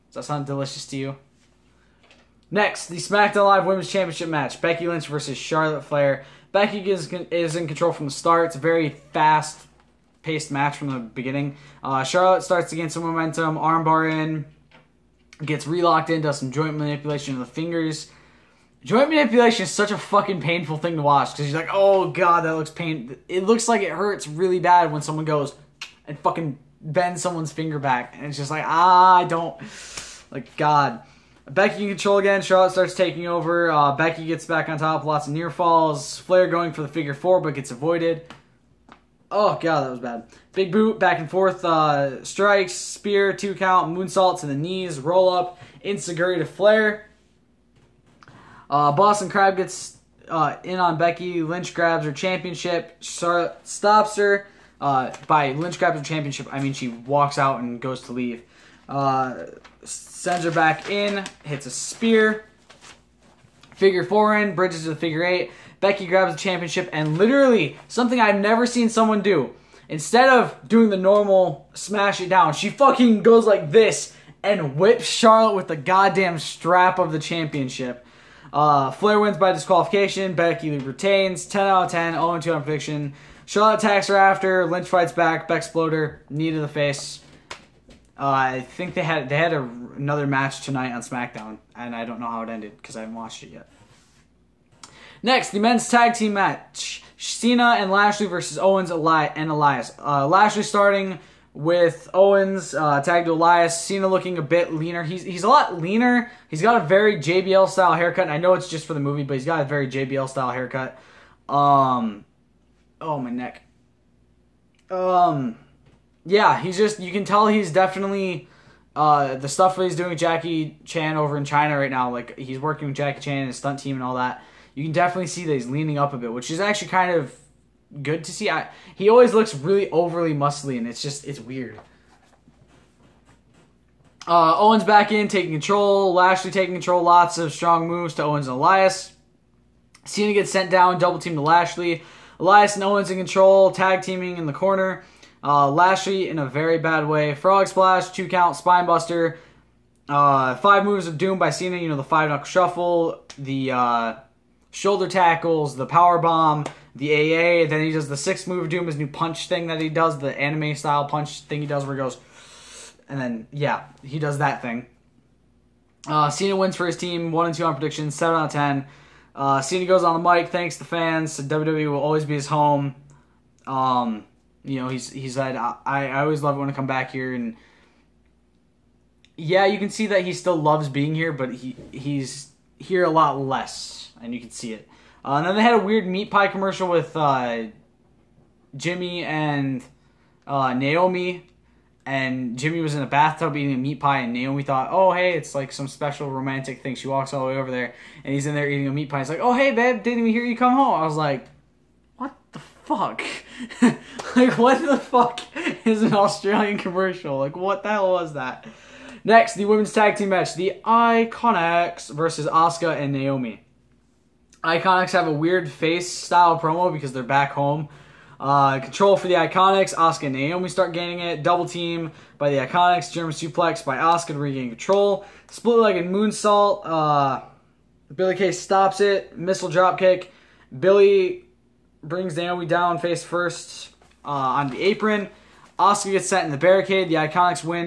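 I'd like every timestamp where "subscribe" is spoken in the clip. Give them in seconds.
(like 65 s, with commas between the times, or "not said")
not said.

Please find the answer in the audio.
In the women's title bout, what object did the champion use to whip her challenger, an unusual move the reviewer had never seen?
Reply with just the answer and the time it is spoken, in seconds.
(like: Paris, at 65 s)
Strap of the championship, at 76 s.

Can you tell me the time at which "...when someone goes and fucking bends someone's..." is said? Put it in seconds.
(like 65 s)
24 s.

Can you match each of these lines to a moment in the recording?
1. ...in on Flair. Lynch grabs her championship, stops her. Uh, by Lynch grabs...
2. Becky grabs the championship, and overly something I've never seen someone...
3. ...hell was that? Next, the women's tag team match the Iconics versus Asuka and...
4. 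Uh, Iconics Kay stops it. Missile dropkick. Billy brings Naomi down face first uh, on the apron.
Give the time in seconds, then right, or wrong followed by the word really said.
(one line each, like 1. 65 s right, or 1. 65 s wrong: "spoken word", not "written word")
1. 50 s wrong: "Becky", not "Flair"
2. 65 s wrong: "literally", not "overly"
3. 207 s right
4. 226 s wrong: "Billy", not "Iconics".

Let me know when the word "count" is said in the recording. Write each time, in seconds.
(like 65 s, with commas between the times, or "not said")
43 s, 148 s.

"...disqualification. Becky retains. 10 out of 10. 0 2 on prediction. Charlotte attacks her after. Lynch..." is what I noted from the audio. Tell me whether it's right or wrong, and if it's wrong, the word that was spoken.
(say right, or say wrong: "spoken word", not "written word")
right.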